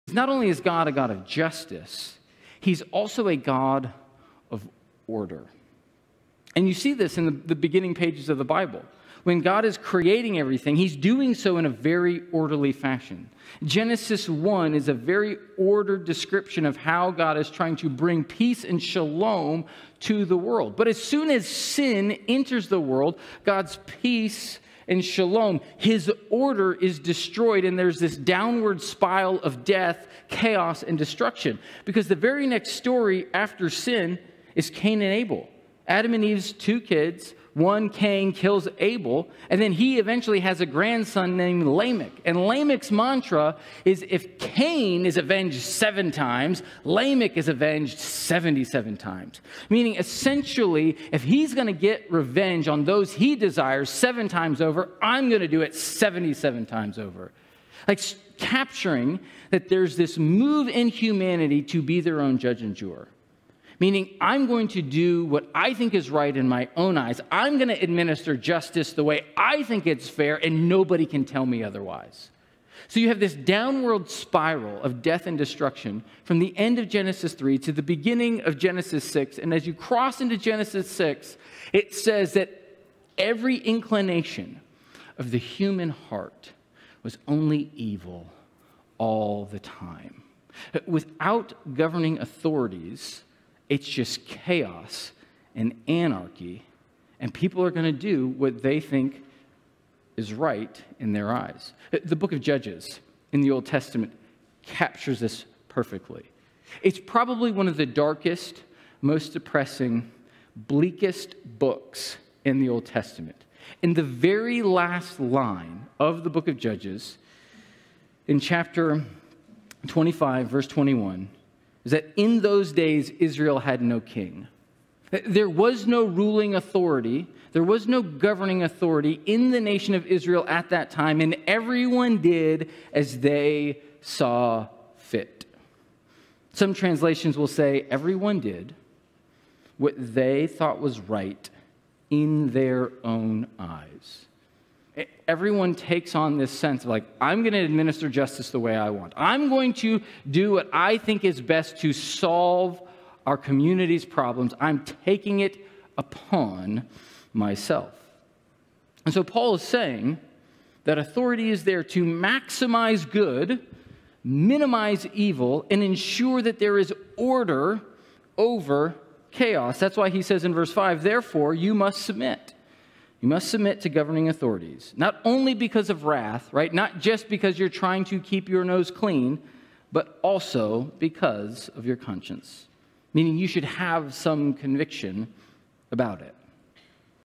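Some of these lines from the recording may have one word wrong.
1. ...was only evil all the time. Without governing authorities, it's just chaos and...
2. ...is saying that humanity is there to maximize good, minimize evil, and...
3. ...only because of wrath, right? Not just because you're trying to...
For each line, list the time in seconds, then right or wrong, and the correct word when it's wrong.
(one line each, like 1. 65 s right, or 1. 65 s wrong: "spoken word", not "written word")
1. 87 s right
2. 159 s wrong: "authority", not "humanity"
3. 175 s right.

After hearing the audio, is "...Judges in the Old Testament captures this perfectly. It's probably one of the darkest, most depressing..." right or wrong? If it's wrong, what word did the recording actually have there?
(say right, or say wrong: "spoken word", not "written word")
right.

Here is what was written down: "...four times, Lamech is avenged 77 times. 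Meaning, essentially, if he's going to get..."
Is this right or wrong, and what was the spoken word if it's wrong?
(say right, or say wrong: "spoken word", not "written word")
wrong: "seven", not "four".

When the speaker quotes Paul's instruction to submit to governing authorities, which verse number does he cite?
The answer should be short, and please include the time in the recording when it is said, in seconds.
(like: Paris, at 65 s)
5, at 170 s.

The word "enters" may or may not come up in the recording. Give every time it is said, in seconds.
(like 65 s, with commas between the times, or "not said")
22 s.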